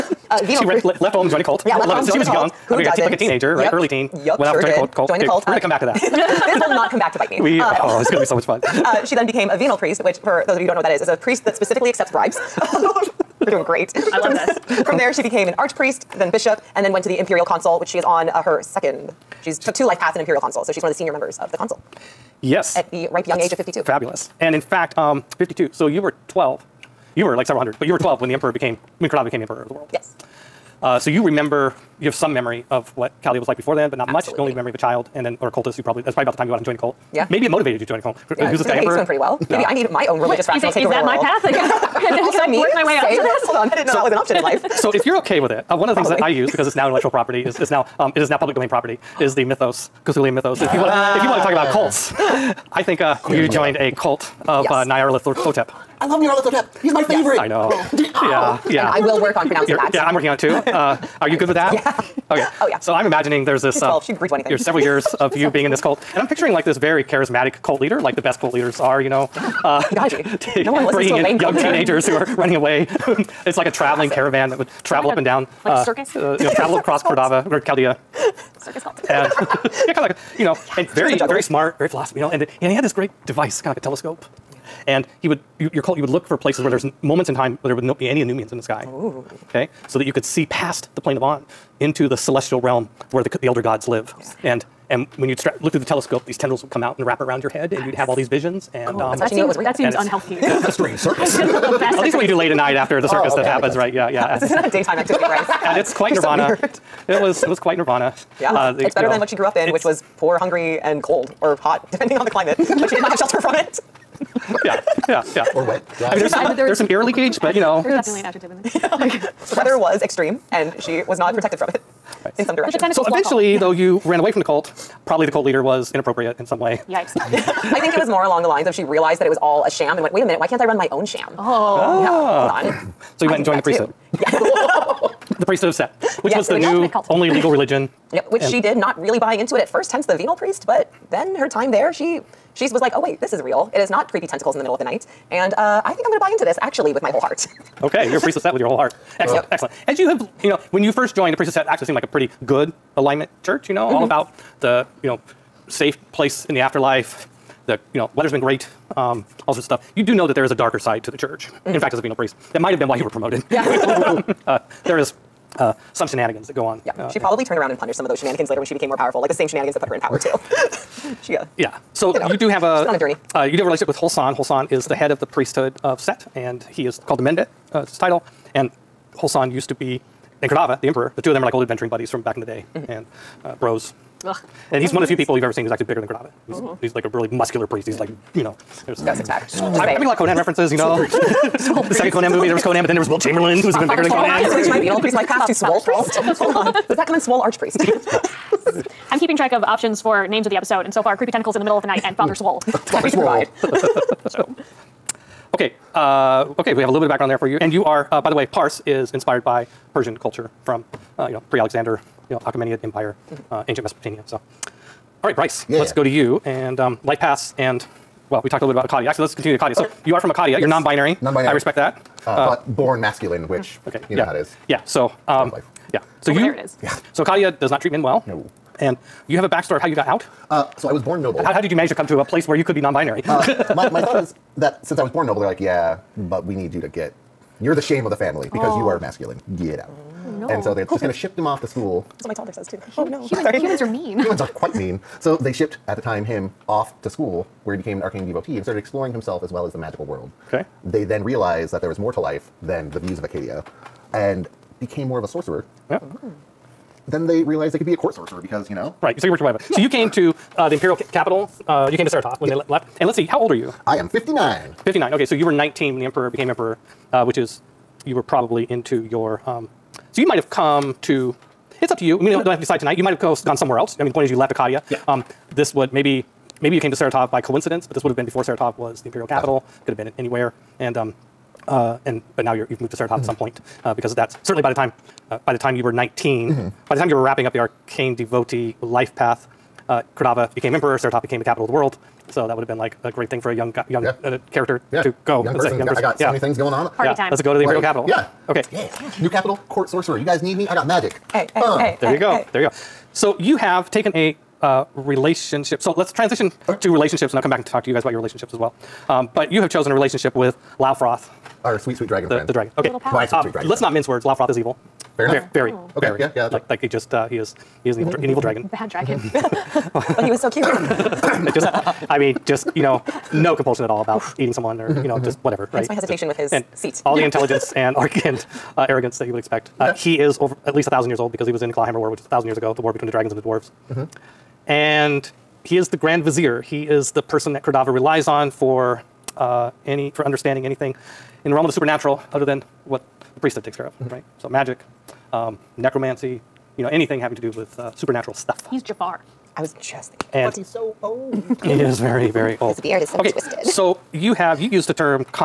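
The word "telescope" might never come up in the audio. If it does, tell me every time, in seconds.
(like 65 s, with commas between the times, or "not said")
83 s, 95 s.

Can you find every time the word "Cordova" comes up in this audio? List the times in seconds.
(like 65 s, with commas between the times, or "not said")
77 s, 337 s.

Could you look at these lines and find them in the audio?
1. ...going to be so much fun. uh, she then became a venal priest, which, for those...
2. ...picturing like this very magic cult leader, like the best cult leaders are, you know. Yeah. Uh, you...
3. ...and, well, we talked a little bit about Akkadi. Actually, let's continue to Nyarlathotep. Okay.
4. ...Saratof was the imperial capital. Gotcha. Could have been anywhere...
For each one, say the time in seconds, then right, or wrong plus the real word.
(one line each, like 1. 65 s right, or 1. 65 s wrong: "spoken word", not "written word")
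1. 8 s right
2. 66 s wrong: "charismatic", not "magic"
3. 217 s wrong: "Akkadi", not "Nyarlathotep"
4. 278 s right.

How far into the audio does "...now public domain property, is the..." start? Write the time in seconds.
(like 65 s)
48 s.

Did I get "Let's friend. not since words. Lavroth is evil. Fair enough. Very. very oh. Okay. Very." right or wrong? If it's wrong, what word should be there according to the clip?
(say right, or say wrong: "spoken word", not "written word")
wrong: "mince", not "since".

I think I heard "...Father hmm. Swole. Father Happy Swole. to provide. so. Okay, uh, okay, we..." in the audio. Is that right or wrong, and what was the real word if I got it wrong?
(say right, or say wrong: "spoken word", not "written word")
right.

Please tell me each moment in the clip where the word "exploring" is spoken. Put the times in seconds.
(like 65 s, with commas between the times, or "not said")
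248 s.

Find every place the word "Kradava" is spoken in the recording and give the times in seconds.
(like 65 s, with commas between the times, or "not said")
180 s, 186 s, 290 s.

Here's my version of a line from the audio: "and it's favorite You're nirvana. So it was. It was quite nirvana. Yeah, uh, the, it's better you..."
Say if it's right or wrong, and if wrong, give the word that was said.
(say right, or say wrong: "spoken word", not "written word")
wrong: "quite", not "favorite".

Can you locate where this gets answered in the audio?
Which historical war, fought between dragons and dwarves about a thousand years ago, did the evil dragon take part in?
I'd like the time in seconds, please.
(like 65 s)
331 s.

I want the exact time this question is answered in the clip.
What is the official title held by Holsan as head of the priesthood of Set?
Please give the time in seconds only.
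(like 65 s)
177 s.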